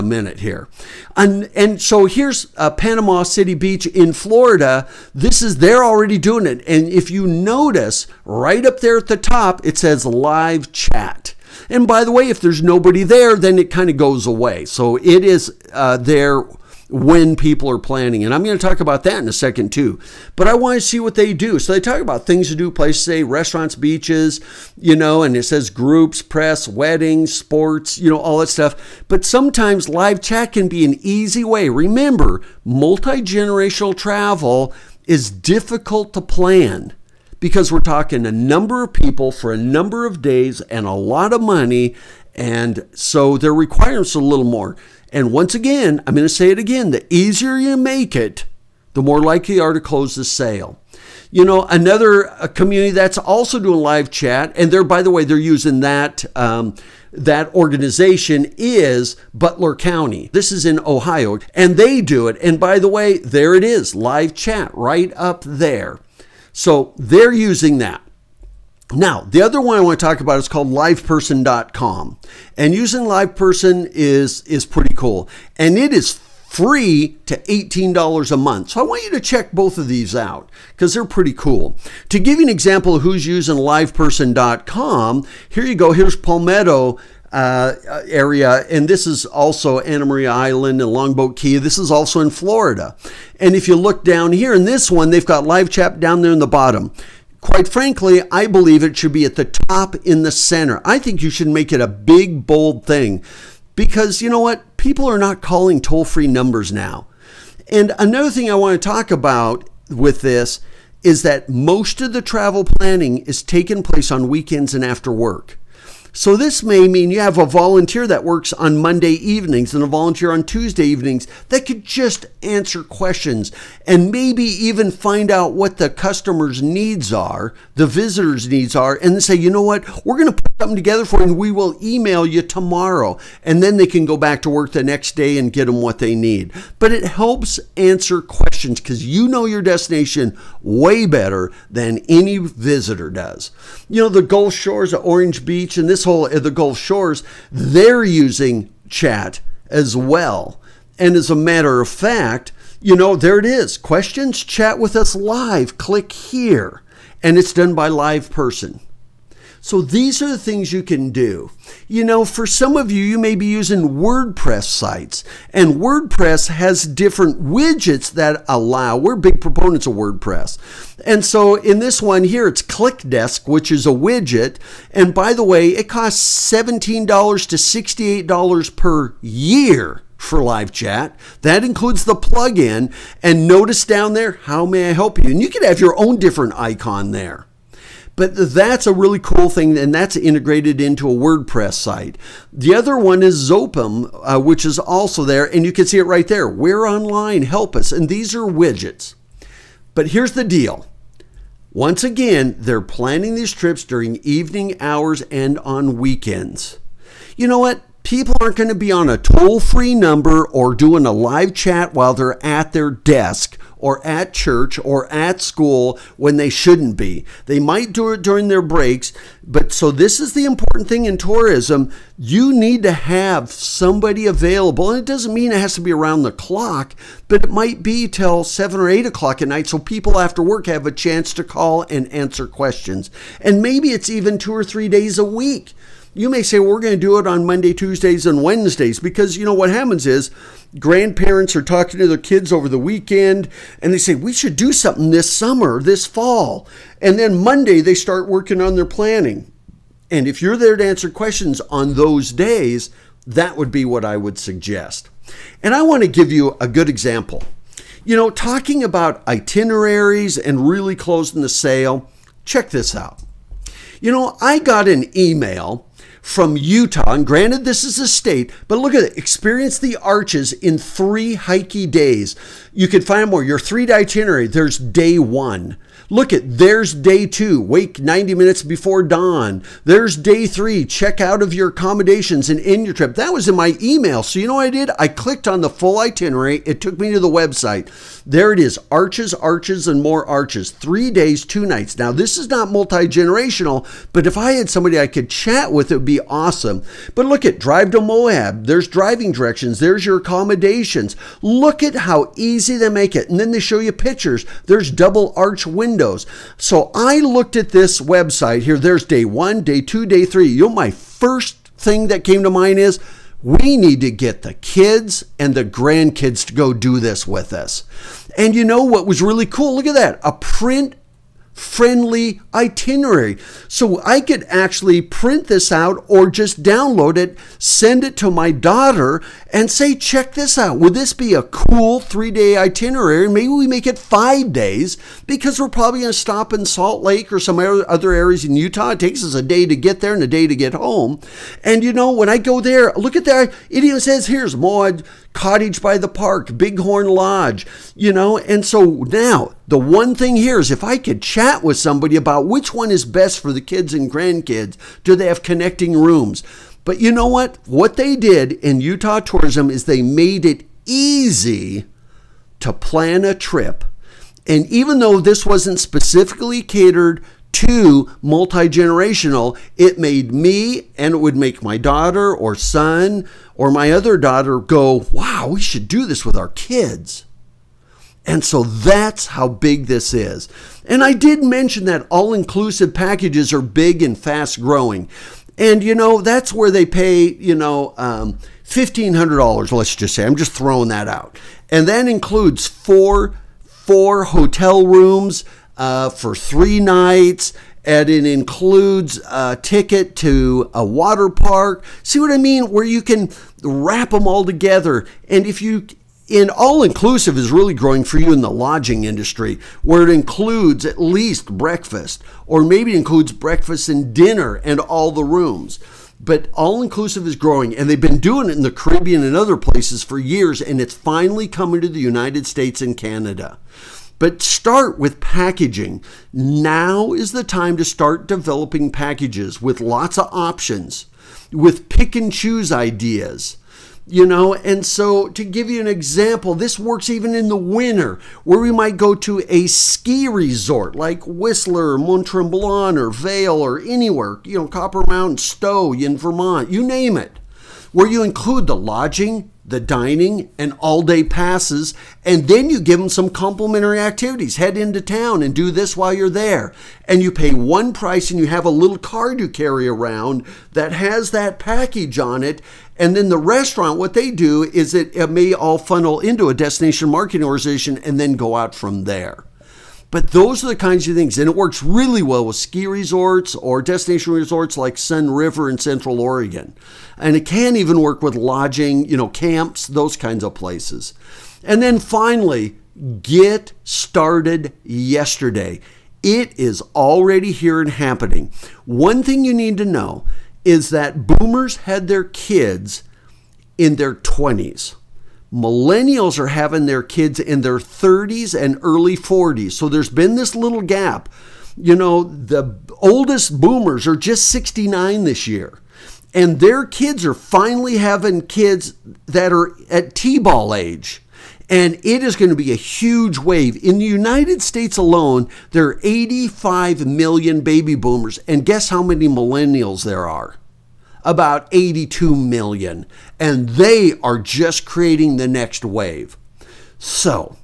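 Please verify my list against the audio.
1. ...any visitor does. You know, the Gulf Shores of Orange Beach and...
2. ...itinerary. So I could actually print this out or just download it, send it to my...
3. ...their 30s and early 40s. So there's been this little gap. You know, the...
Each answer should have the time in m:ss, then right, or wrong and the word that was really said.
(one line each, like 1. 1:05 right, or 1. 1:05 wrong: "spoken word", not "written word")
1. 2:22 right
2. 5:22 right
3. 8:17 right.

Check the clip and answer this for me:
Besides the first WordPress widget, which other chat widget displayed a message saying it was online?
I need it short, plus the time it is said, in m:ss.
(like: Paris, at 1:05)
Zopim, at 3:13.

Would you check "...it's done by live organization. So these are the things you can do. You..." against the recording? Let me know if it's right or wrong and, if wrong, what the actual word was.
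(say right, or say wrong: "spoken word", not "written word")
wrong: "person", not "organization".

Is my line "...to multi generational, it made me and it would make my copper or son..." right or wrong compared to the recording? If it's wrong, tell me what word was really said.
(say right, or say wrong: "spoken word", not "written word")
wrong: "daughter", not "copper".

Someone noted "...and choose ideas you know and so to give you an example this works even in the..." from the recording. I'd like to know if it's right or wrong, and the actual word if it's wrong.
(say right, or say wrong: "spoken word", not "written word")
right.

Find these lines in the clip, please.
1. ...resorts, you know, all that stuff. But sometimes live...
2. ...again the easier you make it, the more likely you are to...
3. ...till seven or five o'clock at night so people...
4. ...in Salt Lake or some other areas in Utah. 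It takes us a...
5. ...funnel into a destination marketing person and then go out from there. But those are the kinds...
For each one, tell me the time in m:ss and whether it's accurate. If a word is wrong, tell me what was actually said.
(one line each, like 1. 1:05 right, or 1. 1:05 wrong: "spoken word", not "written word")
1. 0:27 wrong: "sports", not "resorts"
2. 0:46 right
3. 3:48 wrong: "eight", not "five"
4. 5:36 right
5. 7:45 wrong: "organization", not "person".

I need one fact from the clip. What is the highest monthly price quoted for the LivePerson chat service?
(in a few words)
$18.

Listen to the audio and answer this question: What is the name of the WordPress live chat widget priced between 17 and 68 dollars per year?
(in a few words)
ClickDesk.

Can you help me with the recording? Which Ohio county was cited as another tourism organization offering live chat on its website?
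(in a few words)
Butler County.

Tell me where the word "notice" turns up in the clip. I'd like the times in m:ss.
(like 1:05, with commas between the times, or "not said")
0:07, 3:03.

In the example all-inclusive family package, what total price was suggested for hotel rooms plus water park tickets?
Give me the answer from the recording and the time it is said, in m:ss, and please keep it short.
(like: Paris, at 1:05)
$1,500, at 6:28.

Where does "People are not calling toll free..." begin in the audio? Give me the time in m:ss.
1:44.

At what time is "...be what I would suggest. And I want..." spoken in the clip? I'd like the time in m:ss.
4:13.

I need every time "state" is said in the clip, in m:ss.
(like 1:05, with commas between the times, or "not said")
4:28, 7:02, 8:34.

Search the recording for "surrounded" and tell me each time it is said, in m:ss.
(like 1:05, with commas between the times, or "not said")
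not said.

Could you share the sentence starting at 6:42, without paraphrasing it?
Where you can wrap them all together.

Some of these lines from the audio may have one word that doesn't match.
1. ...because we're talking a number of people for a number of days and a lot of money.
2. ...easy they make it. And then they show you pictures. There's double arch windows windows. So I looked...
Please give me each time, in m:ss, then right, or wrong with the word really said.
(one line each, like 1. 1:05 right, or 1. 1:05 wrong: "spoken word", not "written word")
1. 0:37 right
2. 5:02 right.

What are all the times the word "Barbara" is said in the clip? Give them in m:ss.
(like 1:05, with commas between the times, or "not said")
not said.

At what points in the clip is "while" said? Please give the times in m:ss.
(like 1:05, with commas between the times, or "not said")
3:31, 7:35.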